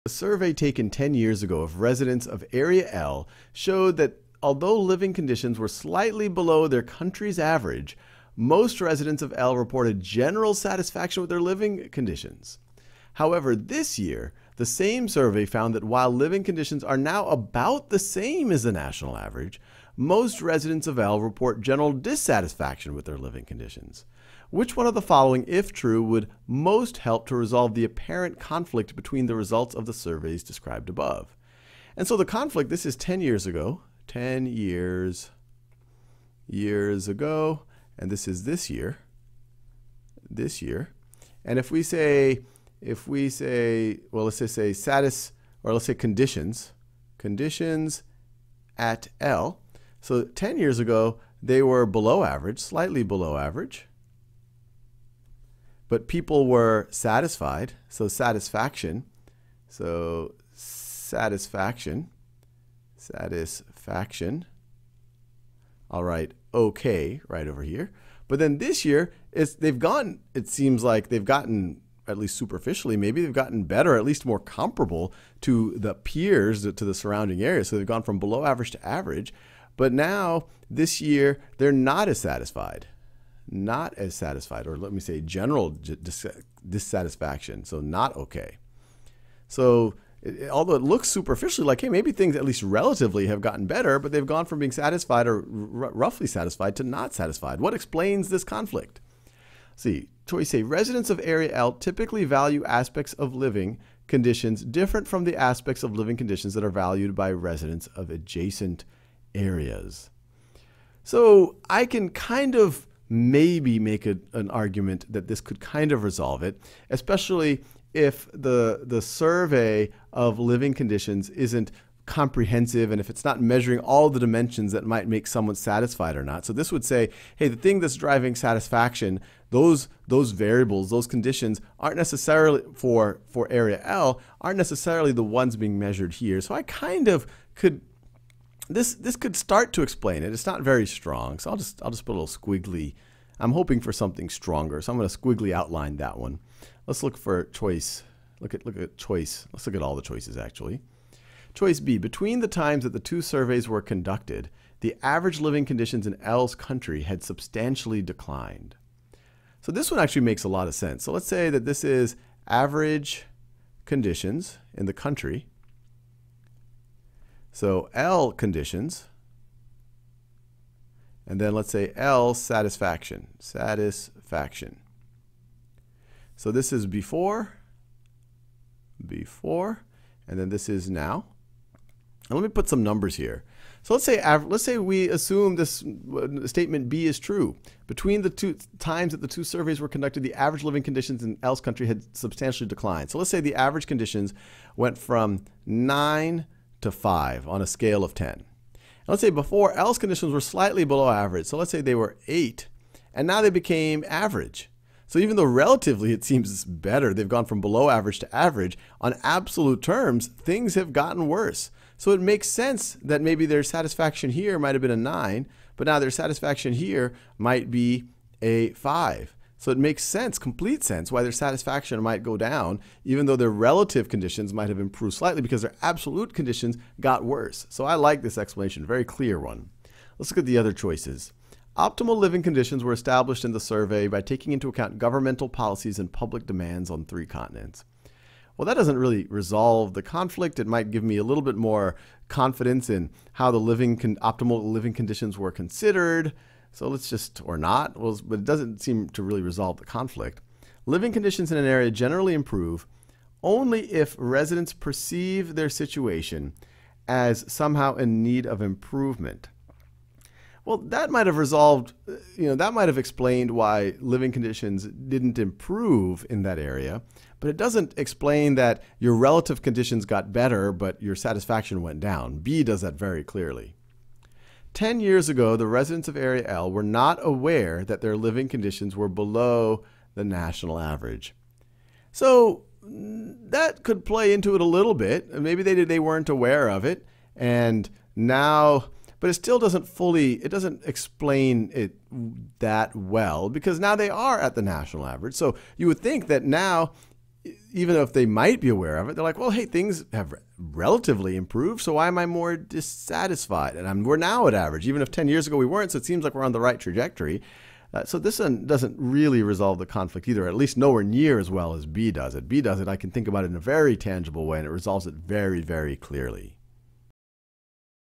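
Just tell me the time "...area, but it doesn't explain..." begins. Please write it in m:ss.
4:26.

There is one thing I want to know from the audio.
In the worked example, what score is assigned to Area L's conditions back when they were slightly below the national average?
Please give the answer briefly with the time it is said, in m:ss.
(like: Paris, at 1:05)
8, at 3:22.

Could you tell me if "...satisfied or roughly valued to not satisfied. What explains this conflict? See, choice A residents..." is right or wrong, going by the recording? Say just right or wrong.
wrong.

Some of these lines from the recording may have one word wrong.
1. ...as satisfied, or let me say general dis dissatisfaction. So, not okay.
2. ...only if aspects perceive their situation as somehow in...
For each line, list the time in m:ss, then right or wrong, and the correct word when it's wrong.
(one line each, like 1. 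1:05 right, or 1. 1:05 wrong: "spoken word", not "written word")
1. 1:23 right
2. 4:13 wrong: "residents", not "aspects".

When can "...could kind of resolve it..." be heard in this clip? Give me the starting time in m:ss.
1:55.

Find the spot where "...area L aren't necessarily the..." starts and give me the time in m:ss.
2:13.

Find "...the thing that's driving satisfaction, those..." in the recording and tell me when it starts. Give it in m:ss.
2:07.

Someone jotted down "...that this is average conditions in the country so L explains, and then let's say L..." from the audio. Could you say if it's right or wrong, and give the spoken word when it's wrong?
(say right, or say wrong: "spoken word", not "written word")
wrong: "conditions", not "explains".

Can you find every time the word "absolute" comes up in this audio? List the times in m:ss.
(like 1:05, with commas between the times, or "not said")
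3:29, 3:45.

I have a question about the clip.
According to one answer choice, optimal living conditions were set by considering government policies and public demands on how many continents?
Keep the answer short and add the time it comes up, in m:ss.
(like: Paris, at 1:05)
3, at 3:57.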